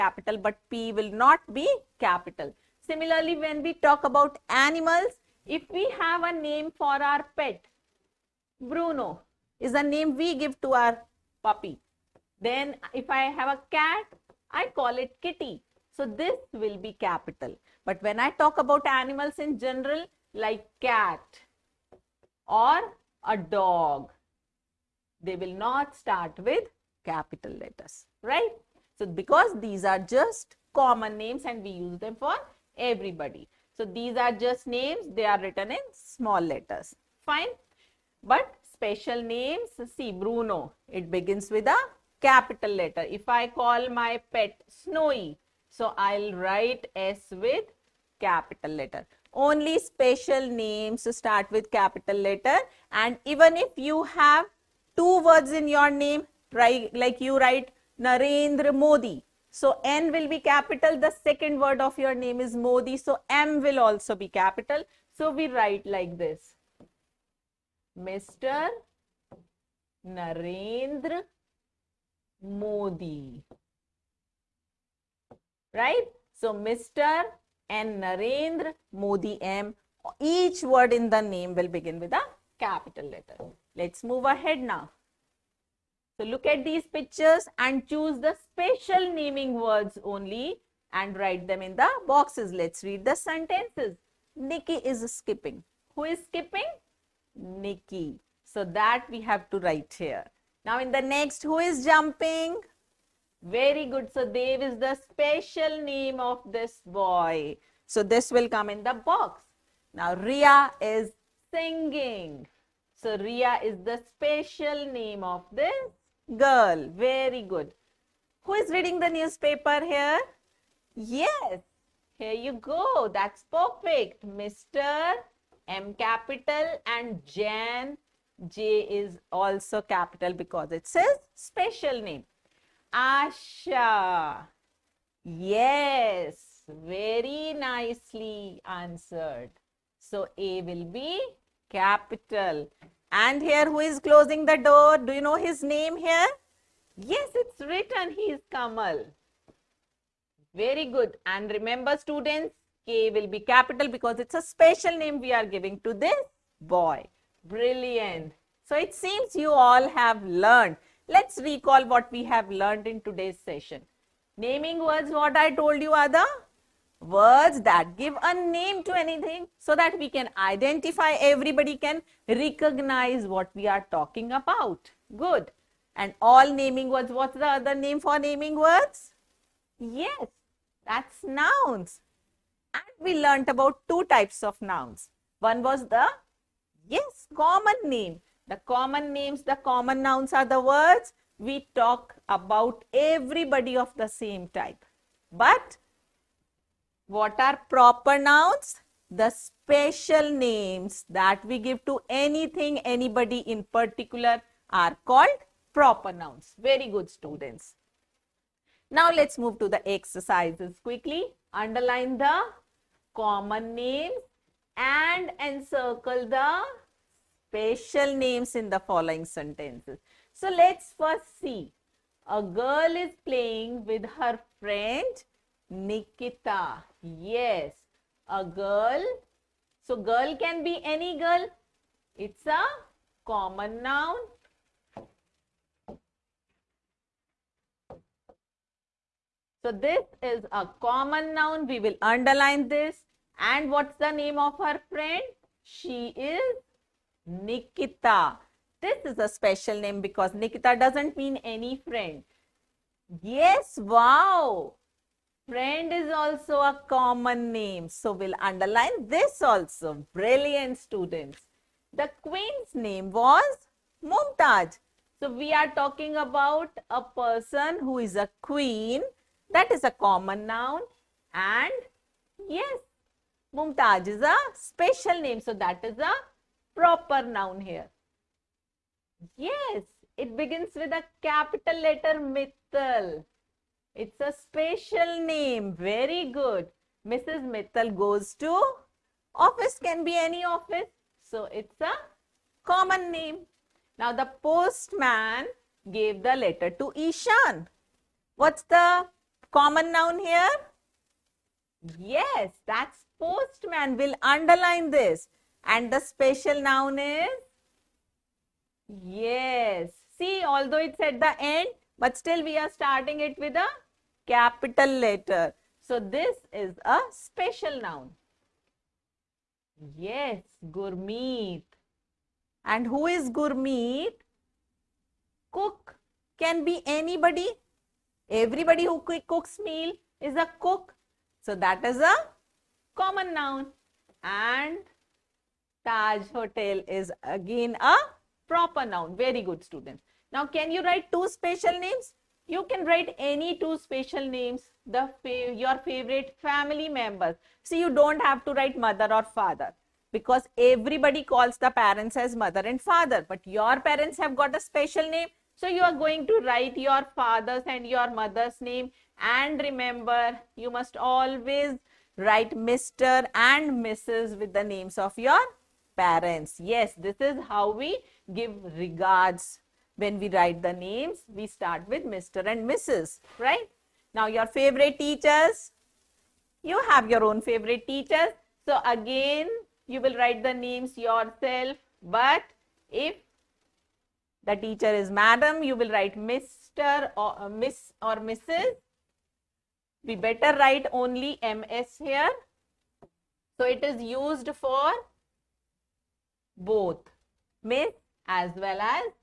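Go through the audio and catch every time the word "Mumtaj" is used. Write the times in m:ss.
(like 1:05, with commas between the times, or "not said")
4:24, 4:33.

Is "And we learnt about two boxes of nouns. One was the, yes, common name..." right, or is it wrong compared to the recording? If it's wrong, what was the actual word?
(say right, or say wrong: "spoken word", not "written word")
wrong: "types", not "boxes".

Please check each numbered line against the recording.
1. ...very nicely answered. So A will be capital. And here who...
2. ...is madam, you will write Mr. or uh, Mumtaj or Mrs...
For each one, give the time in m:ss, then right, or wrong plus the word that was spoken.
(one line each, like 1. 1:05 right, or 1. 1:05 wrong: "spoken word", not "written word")
1. 2:16 right
2. 6:24 wrong: "Miss", not "Mumtaj".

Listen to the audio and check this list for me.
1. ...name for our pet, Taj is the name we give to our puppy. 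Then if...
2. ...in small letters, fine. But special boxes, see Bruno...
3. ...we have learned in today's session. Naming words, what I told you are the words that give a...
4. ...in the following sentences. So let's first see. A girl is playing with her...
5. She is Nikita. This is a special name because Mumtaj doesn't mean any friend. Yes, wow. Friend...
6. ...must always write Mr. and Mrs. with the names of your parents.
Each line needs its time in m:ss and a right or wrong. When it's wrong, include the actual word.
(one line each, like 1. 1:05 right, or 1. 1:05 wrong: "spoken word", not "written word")
1. 0:06 wrong: "Bruno", not "Taj"
2. 0:35 wrong: "names", not "boxes"
3. 2:42 right
4. 3:38 right
5. 4:05 wrong: "Nikita", not "Mumtaj"
6. 6:00 right.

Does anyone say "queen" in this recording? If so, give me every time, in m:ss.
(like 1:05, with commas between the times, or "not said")
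4:22, 4:28.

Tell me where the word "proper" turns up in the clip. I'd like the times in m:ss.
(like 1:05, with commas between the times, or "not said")
3:17, 3:25, 4:36, 5:38.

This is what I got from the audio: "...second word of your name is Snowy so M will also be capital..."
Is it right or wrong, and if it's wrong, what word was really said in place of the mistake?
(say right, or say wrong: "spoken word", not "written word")
wrong: "Modi", not "Snowy".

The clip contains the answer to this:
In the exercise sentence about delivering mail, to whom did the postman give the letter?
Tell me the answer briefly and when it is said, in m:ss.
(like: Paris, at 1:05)
Ishan, at 4:56.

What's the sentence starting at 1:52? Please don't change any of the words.
So, Ria is the special name of this girl.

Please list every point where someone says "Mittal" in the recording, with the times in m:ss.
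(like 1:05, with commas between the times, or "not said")
4:42, 4:47.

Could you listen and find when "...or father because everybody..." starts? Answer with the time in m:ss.
5:49.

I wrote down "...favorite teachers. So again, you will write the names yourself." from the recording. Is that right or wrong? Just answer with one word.
right.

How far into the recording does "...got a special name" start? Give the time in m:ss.
5:54.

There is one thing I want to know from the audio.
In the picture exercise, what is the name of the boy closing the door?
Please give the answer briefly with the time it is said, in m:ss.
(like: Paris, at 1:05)
Kamal, at 2:28.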